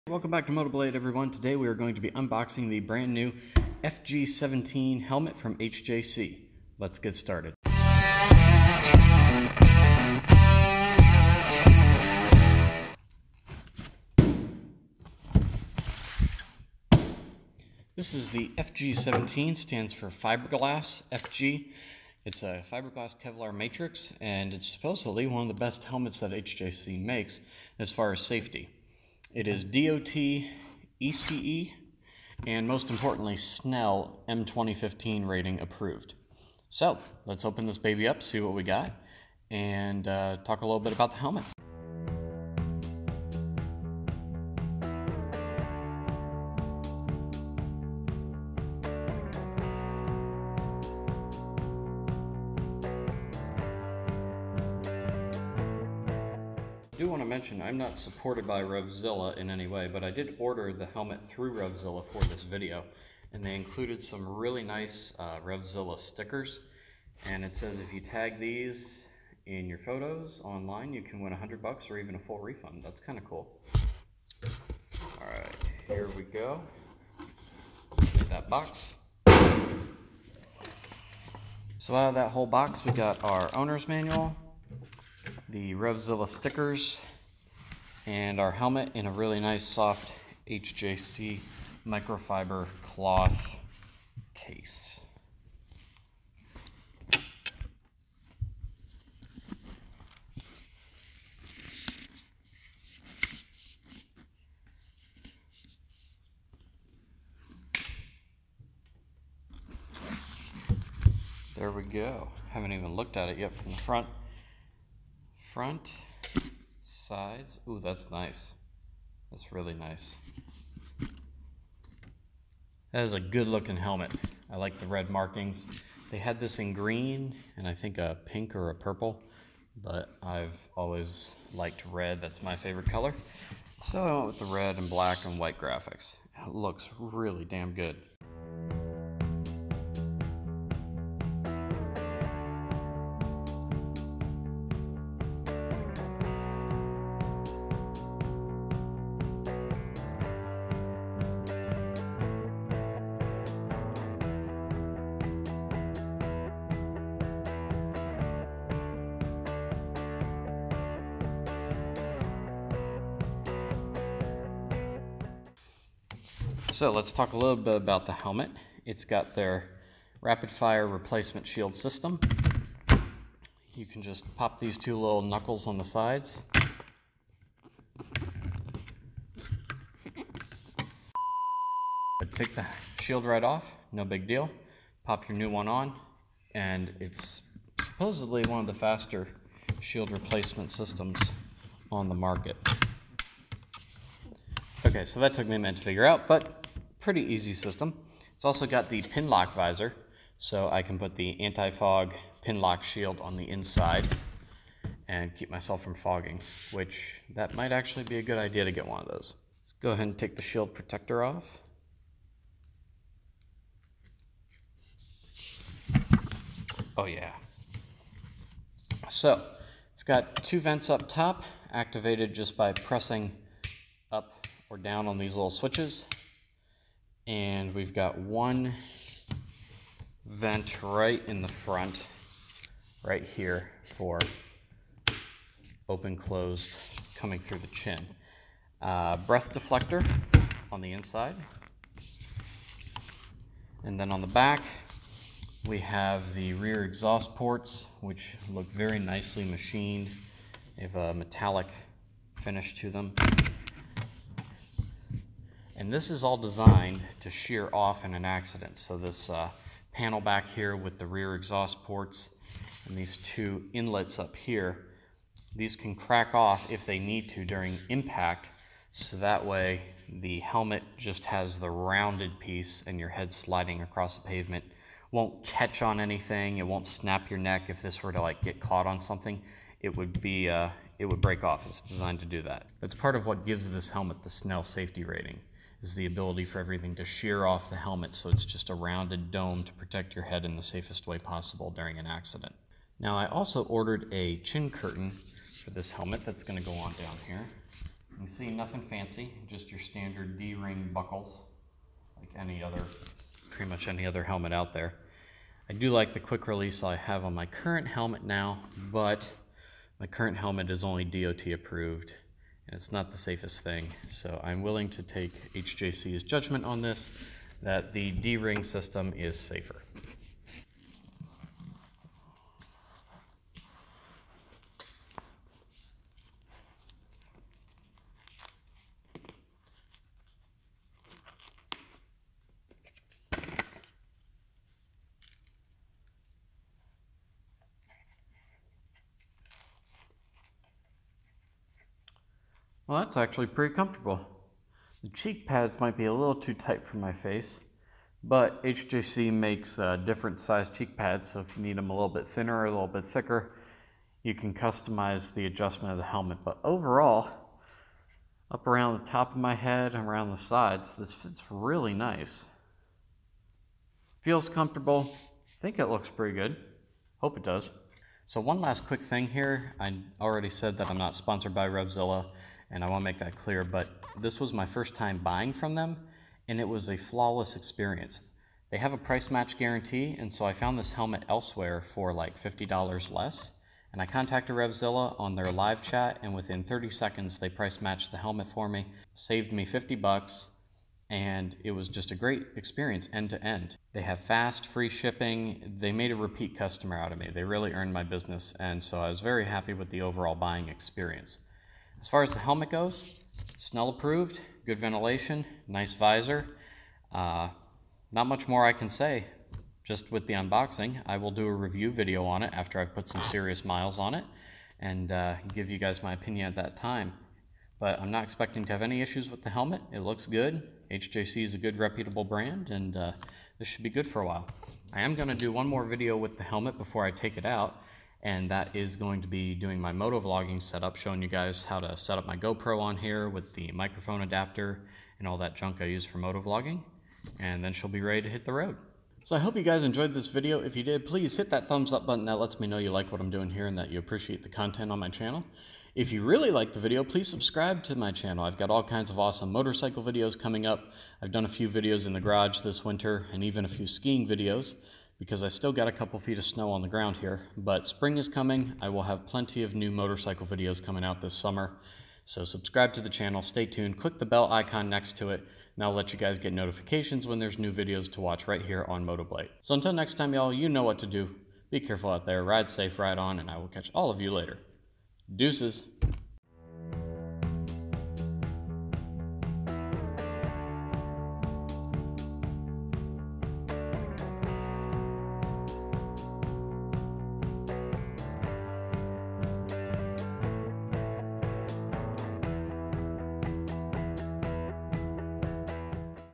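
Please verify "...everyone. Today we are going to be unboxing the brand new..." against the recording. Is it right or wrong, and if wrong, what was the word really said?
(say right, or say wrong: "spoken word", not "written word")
right.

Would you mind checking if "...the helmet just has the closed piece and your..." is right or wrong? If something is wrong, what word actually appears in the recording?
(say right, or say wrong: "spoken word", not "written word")
wrong: "rounded", not "closed".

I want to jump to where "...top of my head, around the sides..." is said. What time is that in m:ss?
5:59.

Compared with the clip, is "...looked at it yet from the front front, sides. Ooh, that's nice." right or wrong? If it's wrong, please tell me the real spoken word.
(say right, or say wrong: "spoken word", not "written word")
right.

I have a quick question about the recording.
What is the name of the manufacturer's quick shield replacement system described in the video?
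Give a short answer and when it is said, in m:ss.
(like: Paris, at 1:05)
rapid fire, at 2:50.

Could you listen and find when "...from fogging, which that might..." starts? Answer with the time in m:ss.
3:25.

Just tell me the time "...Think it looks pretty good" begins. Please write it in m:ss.
6:05.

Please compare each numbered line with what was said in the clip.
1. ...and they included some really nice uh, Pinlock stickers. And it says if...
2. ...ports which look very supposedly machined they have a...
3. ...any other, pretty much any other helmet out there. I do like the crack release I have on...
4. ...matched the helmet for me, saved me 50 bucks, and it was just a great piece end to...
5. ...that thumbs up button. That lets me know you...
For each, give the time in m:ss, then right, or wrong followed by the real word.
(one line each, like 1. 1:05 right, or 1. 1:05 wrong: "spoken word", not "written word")
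1. 1:03 wrong: "RevZilla", not "Pinlock"
2. 4:07 wrong: "nicely", not "supposedly"
3. 5:02 wrong: "quick", not "crack"
4. 6:27 wrong: "experience", not "piece"
5. 7:21 right.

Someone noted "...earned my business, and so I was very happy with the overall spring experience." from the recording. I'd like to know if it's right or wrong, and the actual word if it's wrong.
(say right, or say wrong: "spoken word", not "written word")
wrong: "buying", not "spring".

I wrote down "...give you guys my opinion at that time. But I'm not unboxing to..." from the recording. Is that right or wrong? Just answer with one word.
wrong.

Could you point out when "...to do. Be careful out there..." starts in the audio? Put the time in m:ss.
7:50.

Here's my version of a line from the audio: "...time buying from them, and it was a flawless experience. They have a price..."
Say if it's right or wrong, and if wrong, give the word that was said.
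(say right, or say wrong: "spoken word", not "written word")
right.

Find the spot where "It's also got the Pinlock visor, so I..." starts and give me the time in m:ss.
3:18.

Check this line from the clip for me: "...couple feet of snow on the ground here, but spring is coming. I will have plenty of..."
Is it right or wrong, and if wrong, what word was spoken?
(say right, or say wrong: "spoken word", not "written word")
right.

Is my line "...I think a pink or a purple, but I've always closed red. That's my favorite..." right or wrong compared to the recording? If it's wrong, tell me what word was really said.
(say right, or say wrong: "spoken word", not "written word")
wrong: "liked", not "closed".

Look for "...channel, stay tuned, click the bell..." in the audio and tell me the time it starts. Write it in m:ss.
7:43.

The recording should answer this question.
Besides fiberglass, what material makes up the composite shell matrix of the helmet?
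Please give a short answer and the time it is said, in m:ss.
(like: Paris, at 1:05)
Kevlar, at 0:23.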